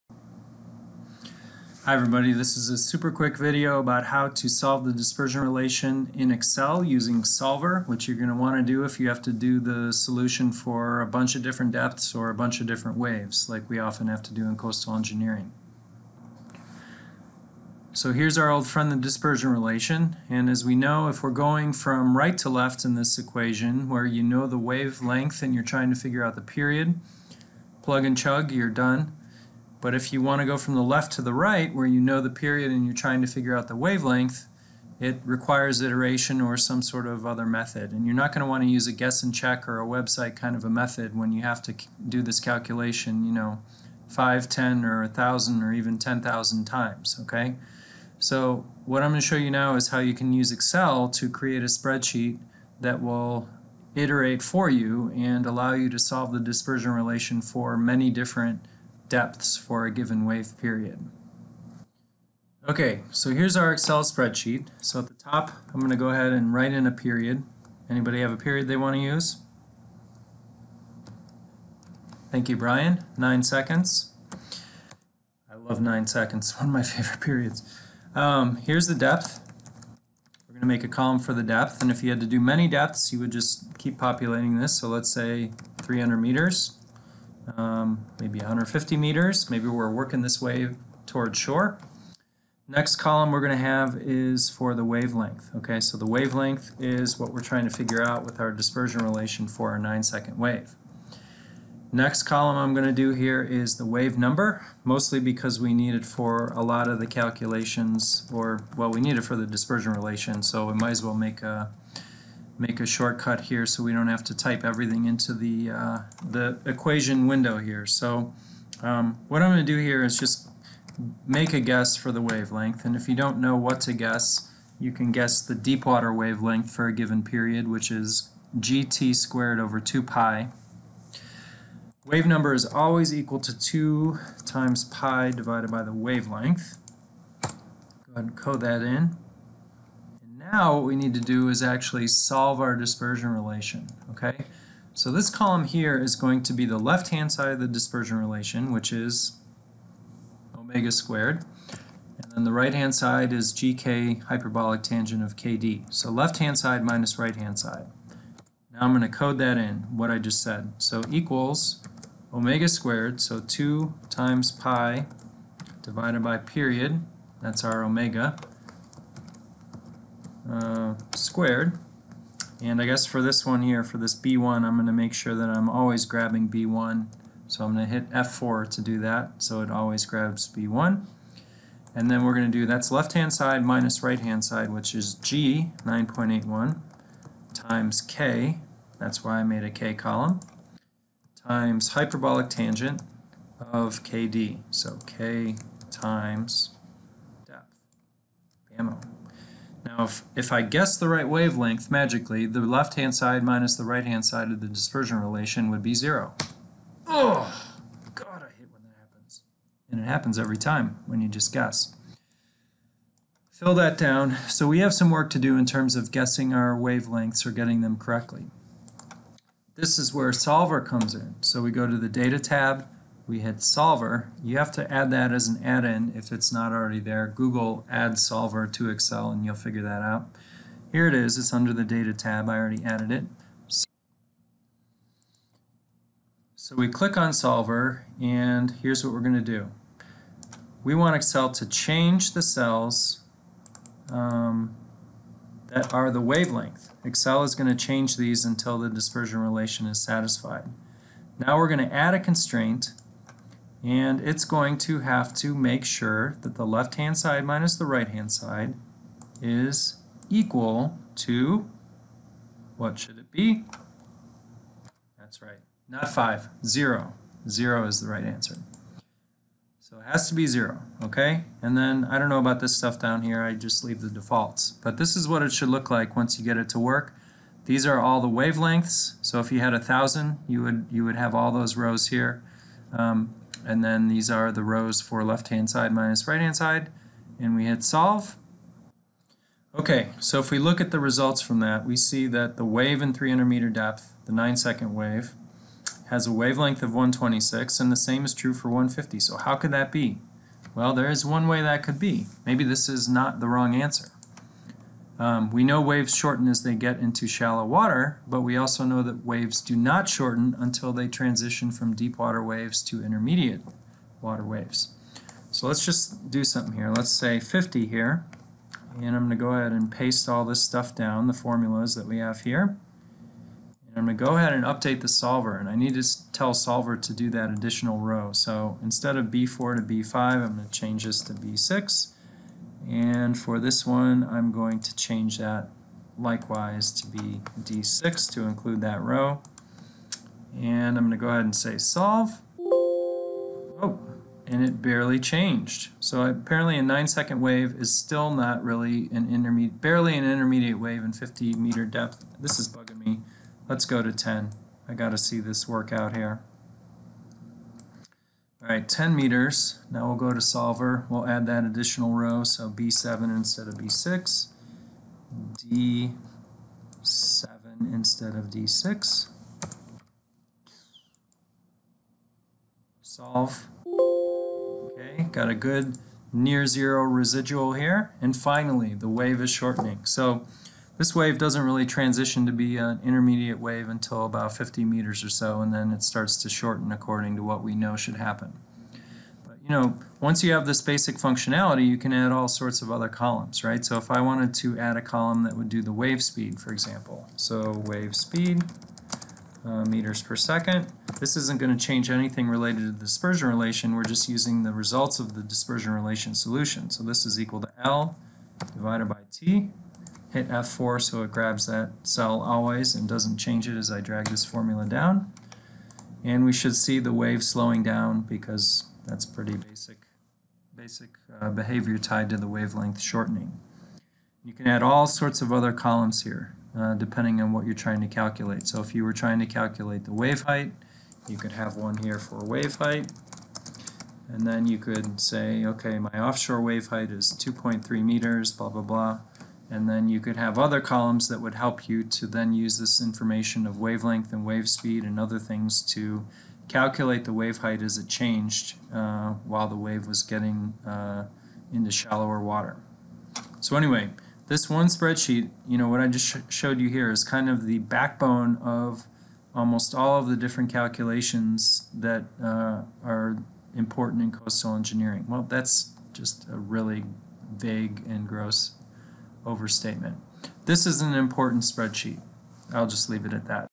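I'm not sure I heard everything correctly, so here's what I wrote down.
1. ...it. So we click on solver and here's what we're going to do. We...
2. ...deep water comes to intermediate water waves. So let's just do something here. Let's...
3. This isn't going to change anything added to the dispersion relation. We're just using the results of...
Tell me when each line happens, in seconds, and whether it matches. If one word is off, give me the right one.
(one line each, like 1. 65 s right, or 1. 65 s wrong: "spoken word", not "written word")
1. 233 s right
2. 311 s wrong: "waves", not "comes"
3. 401 s wrong: "related", not "added".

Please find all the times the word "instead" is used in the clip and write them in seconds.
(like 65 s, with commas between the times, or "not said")
328 s, 363 s, 367 s.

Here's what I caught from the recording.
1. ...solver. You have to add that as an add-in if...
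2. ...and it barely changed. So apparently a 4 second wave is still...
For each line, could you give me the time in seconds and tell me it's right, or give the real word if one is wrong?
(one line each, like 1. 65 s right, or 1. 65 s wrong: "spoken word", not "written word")
1. 223 s right
2. 344 s wrong: "9", not "4".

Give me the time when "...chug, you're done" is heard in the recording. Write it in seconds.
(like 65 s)
28 s.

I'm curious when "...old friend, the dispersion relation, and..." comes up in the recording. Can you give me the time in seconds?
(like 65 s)
18 s.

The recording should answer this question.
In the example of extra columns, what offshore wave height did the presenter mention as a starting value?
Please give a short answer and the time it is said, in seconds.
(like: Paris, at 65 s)
2.3 meters, at 437 s.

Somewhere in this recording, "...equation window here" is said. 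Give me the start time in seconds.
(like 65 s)
116 s.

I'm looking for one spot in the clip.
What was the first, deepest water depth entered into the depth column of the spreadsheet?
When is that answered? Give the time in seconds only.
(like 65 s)
85 s.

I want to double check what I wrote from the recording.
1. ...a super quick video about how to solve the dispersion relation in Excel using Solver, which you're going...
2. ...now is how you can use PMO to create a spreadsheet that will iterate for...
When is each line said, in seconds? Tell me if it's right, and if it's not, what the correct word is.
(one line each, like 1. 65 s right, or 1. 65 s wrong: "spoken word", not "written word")
1. 2 s right
2. 49 s wrong: "Excel", not "PMO".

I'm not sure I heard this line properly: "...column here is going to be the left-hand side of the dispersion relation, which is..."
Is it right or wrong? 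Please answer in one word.
right.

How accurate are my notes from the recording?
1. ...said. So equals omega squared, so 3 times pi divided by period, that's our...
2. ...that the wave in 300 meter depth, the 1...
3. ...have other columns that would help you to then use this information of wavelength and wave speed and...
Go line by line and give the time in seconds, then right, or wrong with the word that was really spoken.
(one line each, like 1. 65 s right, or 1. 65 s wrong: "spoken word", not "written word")
1. 160 s wrong: "2", not "3"
2. 292 s wrong: "9", not "1"
3. 440 s right.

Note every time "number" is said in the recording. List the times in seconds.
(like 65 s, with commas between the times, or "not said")
104 s, 132 s.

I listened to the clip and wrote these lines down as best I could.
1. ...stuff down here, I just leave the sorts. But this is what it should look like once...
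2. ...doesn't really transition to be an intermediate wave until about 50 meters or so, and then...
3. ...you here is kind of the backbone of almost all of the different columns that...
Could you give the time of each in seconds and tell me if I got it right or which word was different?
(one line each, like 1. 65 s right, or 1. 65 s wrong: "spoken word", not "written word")
1. 272 s wrong: "defaults", not "sorts"
2. 381 s right
3. 456 s wrong: "calculations", not "columns".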